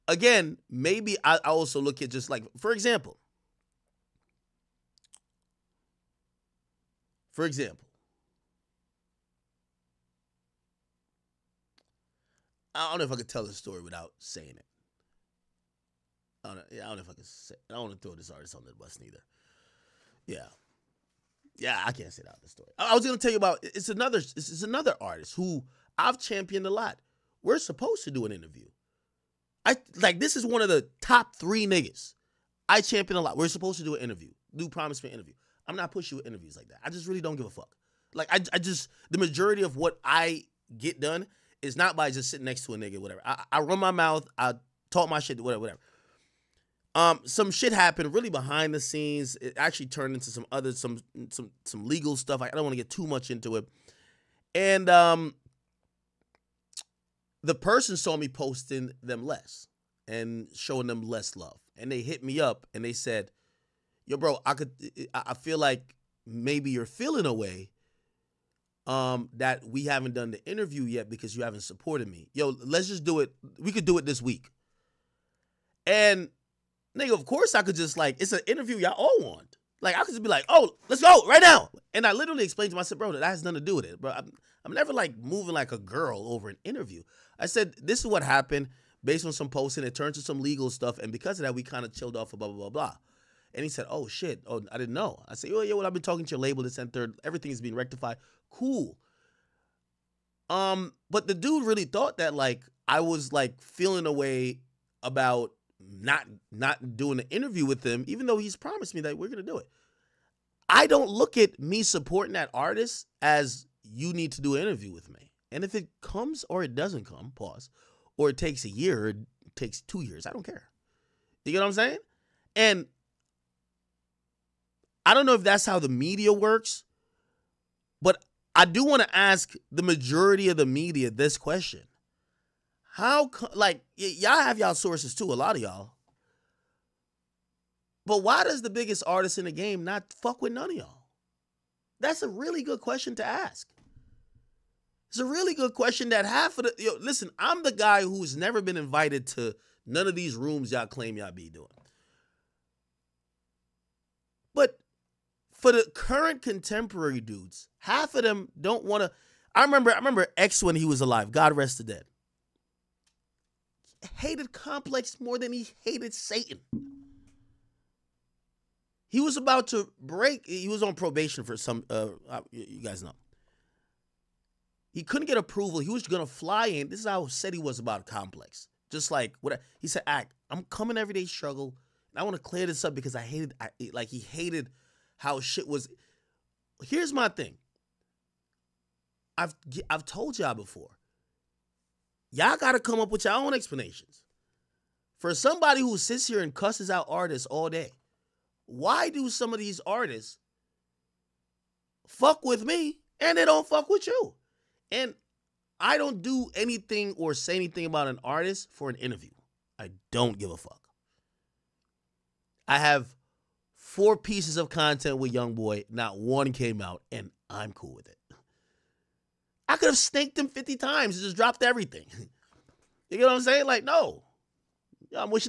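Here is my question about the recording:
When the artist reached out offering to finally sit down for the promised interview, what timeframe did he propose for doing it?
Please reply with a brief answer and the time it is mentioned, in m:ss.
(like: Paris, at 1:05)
this week, at 1:14.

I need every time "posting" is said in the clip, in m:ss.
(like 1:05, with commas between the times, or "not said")
0:58, 1:29.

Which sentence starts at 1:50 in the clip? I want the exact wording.
I don't look at me supporting that artist as you need to do an interview with me.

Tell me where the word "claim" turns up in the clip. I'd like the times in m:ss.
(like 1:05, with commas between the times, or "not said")
2:30.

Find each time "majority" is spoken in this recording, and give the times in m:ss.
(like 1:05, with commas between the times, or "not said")
0:39, 2:09.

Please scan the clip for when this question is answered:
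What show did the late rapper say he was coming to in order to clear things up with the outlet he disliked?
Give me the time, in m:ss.
3:00.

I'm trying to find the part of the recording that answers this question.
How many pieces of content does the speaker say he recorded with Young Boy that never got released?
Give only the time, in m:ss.
3:33.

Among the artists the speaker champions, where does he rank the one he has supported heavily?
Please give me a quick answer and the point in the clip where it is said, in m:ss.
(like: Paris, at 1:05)
top three, at 0:31.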